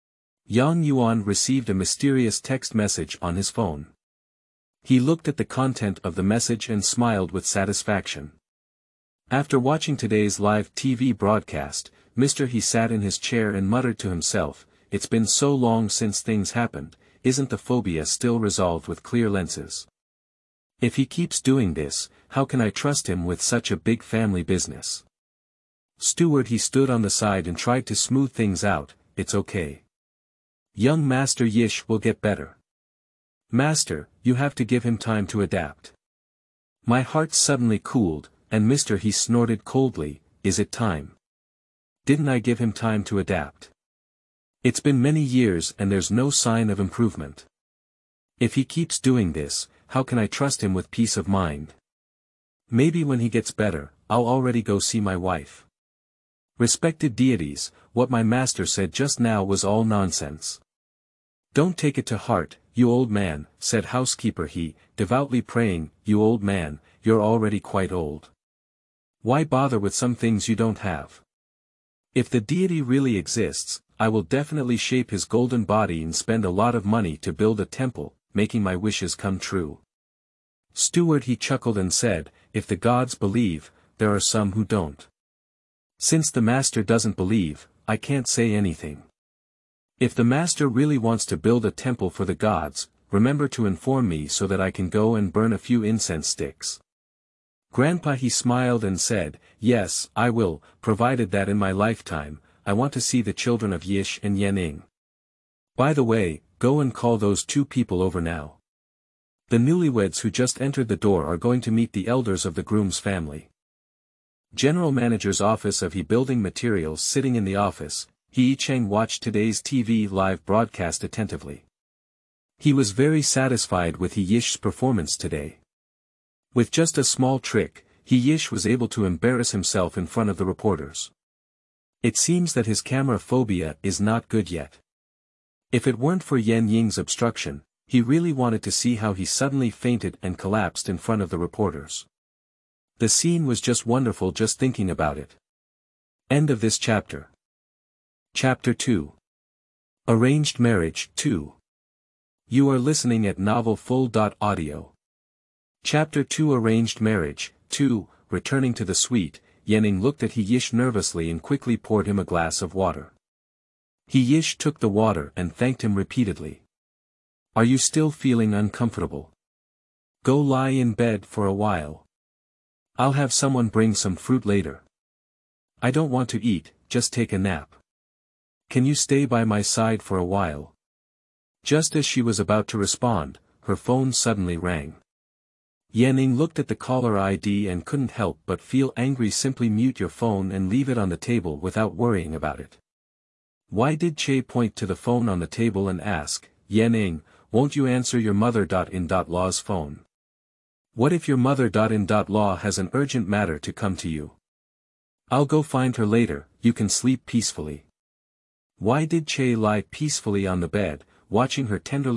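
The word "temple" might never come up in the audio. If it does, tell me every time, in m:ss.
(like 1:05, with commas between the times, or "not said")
1:17, 1:31.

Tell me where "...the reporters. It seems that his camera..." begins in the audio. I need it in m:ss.
2:10.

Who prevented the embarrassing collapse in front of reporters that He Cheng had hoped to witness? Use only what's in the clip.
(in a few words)
Yan Ying.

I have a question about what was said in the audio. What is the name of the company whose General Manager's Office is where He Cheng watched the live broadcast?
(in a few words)
He Building Materials.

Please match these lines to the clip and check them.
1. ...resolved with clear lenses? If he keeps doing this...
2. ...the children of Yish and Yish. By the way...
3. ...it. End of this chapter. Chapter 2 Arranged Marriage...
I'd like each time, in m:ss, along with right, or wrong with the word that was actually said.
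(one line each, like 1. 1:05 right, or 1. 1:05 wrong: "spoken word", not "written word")
1. 0:18 right
2. 1:43 wrong: "Yaning", not "Yish"
3. 2:25 right.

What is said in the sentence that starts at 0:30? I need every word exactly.
Young Master Yish will get better.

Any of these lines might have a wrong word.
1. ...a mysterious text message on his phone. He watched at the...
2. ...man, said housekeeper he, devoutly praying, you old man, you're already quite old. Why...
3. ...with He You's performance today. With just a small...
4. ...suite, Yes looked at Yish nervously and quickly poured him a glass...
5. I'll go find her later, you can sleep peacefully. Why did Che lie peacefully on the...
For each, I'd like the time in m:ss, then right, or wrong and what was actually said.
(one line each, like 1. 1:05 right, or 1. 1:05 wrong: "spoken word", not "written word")
1. 0:01 wrong: "looked", not "watched"
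2. 1:03 right
3. 2:03 wrong: "Yish", not "You"
4. 2:38 wrong: "Yenning", not "Yes"
5. 3:25 right.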